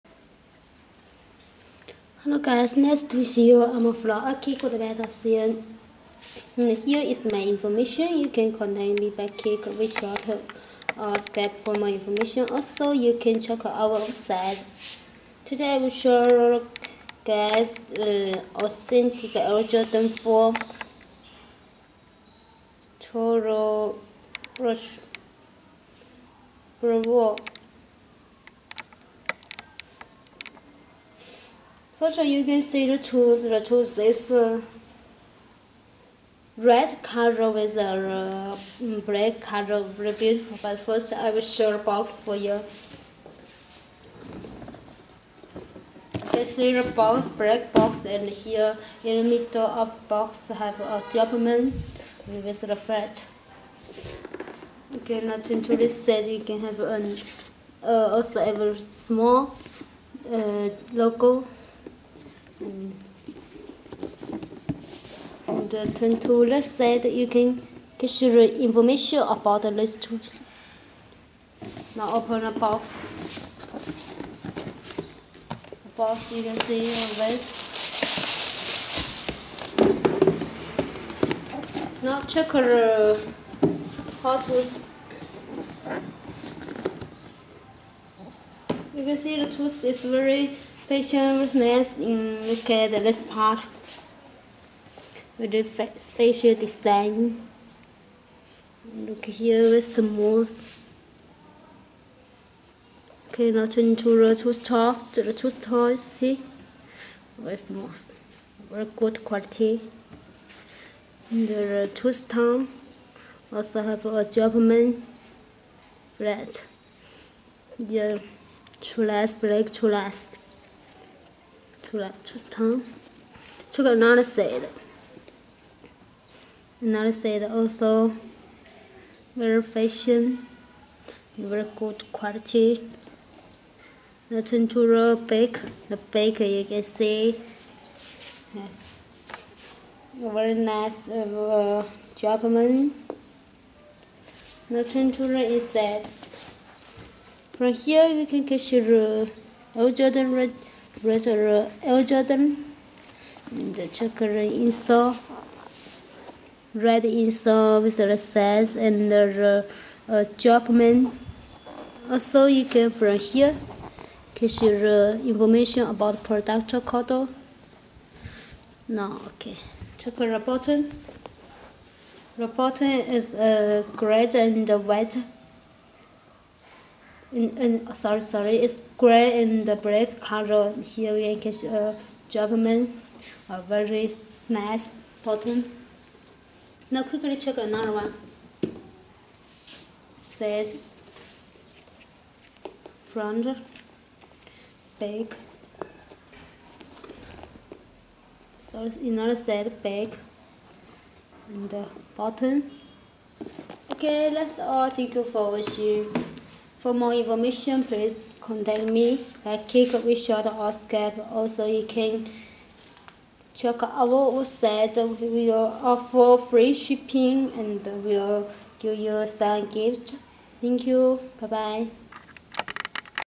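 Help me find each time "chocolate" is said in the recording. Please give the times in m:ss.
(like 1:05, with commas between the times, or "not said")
2:33, 2:49.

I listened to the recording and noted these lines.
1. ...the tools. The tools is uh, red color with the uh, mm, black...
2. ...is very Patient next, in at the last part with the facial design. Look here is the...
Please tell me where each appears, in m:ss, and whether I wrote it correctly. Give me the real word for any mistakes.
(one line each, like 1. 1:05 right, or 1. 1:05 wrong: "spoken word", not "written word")
1. 0:32 right
2. 1:29 right.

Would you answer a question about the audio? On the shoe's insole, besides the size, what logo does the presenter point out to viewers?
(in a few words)
Jumpman.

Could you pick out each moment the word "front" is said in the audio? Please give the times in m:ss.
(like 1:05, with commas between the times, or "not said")
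3:13.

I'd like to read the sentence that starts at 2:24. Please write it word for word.
The tempura is that from here you can catch the old Jordan red Bretter uh, L.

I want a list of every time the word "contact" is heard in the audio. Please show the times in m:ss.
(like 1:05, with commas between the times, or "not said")
0:08, 3:28.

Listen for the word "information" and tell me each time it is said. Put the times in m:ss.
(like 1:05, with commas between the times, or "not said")
0:07, 0:11, 1:08, 2:45, 3:27.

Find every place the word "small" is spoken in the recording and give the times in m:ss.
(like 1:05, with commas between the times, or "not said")
0:58.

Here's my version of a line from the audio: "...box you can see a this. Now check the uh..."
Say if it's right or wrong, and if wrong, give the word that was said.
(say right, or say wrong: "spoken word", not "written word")
right.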